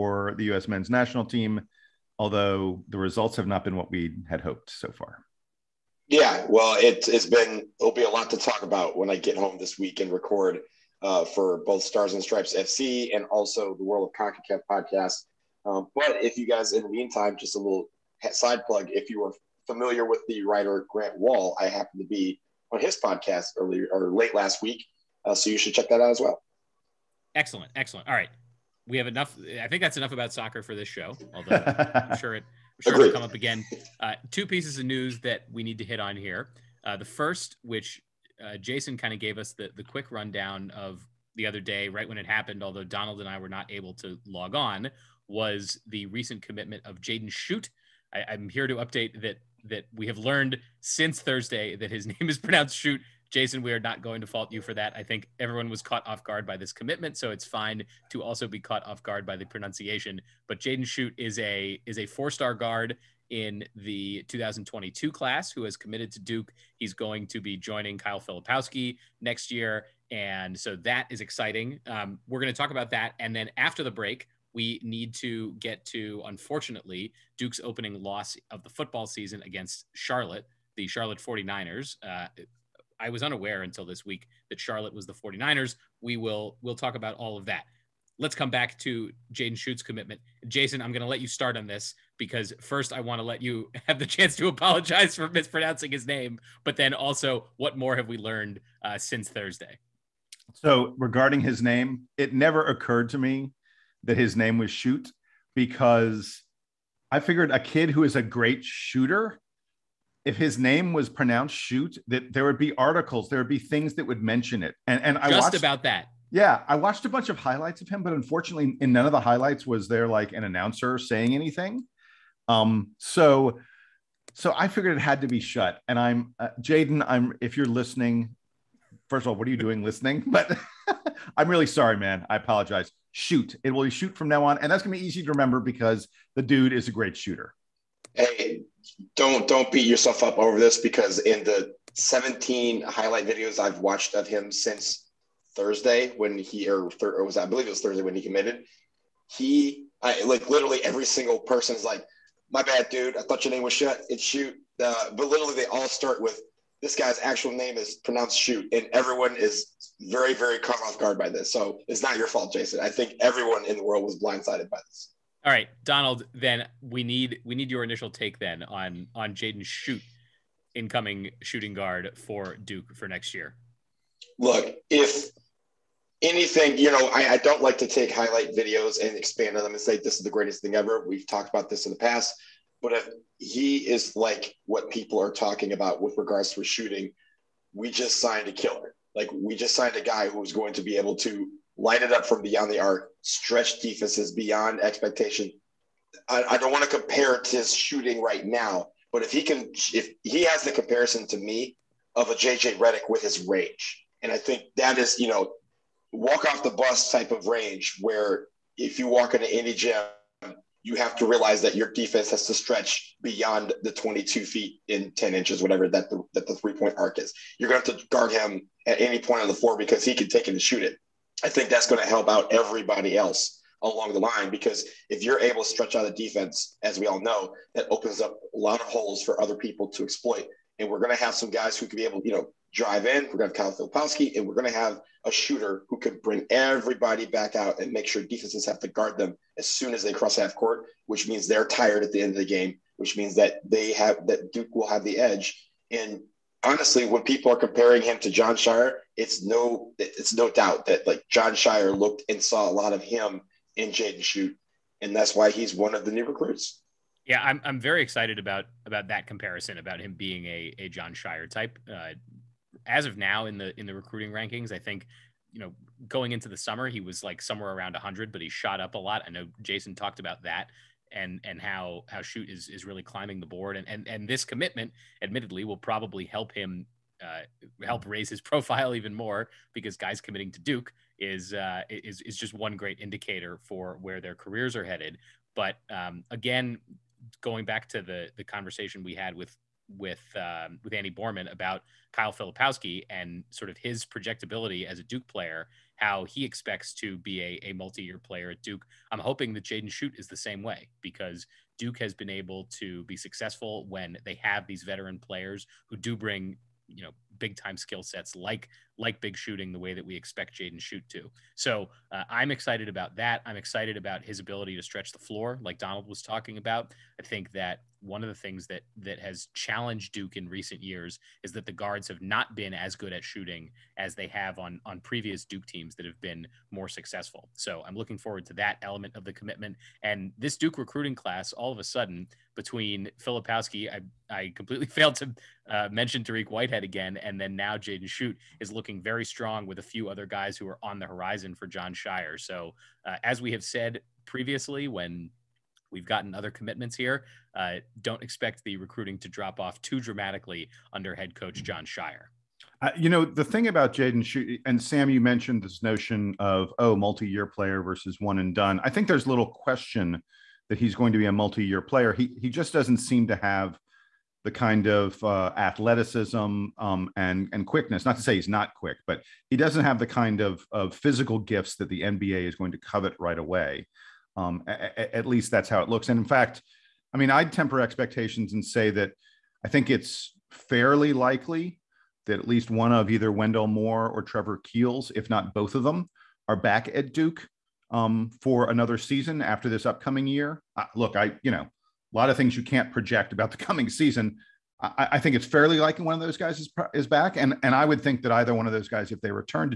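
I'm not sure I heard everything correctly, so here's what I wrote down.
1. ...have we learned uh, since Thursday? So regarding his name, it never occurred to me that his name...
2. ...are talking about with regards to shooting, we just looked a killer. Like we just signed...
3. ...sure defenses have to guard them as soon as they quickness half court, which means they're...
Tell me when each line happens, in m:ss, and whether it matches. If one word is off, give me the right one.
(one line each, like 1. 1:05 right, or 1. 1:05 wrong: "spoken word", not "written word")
1. 1:37 right
2. 3:05 wrong: "signed", not "looked"
3. 3:58 wrong: "cross", not "quickness".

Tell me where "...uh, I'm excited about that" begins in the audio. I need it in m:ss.
5:12.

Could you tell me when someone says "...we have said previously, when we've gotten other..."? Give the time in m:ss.
5:43.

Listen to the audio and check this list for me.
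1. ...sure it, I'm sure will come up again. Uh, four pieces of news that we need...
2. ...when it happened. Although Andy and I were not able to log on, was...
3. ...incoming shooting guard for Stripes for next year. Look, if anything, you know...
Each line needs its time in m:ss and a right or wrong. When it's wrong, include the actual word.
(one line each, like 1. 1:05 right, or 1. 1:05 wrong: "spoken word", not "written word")
1. 0:32 wrong: "two", not "four"
2. 0:42 wrong: "Donald", not "Andy"
3. 2:50 wrong: "Duke", not "Stripes".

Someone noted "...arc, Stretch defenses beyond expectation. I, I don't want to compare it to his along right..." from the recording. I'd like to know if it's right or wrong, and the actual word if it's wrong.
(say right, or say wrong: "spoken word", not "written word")
wrong: "shooting", not "along".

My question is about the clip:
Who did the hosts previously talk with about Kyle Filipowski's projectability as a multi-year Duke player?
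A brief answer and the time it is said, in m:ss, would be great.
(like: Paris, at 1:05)
Andy Borman, at 4:50.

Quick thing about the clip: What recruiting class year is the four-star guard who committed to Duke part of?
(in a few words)
2022.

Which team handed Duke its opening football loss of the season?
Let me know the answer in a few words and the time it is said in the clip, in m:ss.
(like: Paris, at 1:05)
Charlotte 49ers, at 1:20.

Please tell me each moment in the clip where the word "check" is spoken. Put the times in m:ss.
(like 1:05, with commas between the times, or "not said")
0:25.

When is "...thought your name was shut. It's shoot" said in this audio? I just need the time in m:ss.
2:33.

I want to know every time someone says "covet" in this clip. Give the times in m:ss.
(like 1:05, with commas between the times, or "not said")
6:12.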